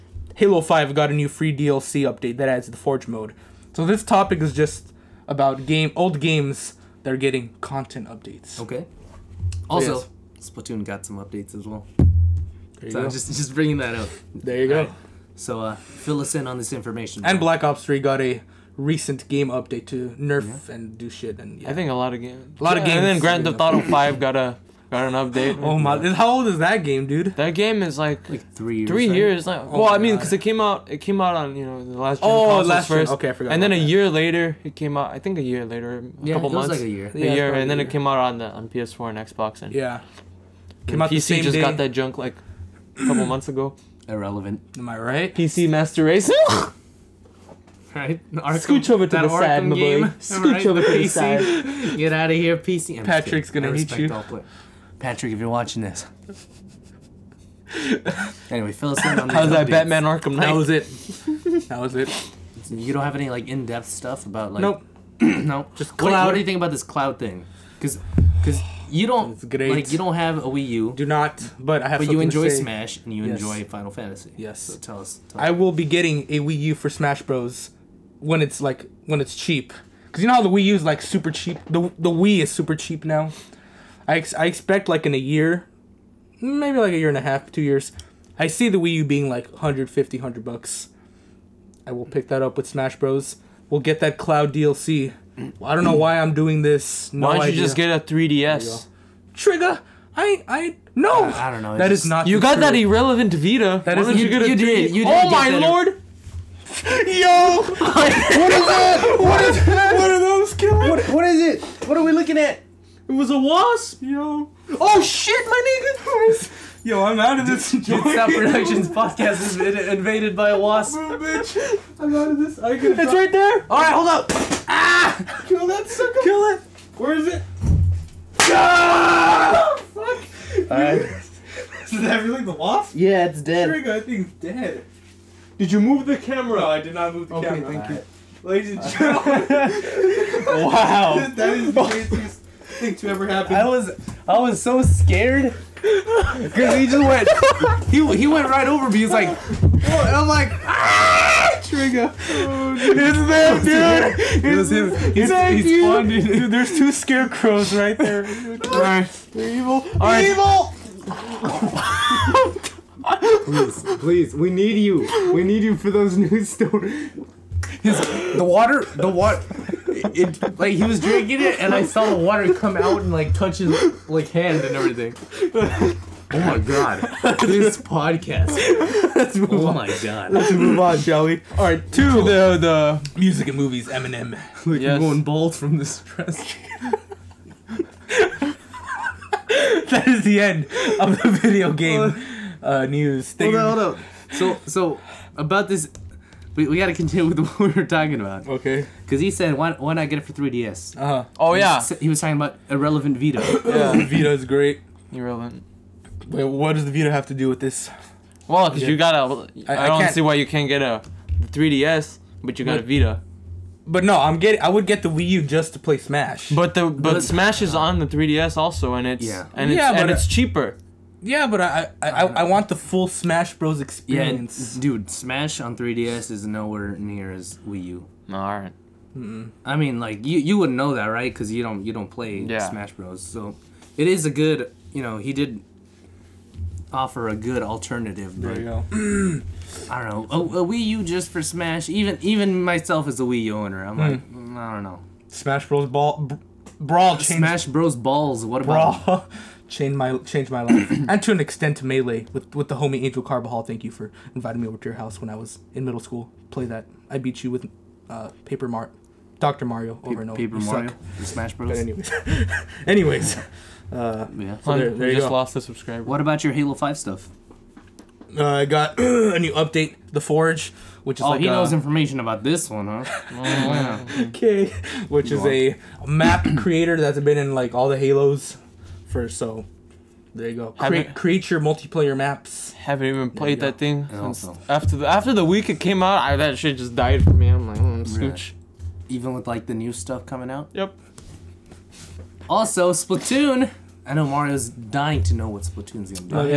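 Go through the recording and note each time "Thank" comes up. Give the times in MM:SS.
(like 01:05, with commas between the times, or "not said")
02:17, 02:35, 04:13.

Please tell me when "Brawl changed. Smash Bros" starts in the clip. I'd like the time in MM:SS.
04:06.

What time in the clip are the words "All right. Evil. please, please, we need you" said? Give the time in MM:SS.
02:39.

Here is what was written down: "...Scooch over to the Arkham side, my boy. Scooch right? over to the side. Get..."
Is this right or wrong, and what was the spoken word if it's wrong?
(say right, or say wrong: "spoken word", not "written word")
right.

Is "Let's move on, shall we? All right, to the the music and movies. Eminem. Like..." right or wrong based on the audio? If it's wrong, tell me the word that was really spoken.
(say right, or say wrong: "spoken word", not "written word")
right.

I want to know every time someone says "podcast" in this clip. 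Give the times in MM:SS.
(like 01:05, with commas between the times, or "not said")
01:58, 02:57.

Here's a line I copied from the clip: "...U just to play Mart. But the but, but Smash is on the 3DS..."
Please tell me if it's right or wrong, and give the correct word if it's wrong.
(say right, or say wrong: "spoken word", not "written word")
wrong: "Smash", not "Mart".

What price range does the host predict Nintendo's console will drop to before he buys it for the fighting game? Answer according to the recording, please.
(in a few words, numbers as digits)
150, 100 bucks.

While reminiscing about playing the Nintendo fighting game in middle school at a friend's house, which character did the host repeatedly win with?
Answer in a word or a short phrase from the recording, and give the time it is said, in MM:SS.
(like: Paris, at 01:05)
Doctor Mario, at 04:19.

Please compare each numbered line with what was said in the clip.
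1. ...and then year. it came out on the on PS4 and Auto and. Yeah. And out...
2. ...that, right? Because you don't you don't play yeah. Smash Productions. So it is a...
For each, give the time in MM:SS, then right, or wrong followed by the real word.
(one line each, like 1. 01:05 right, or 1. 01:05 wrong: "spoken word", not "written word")
1. 00:37 wrong: "Xbox", not "Auto"
2. 03:50 wrong: "Bros", not "Productions".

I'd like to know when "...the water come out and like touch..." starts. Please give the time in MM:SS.
02:52.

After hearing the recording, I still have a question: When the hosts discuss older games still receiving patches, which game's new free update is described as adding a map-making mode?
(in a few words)
Halo 5.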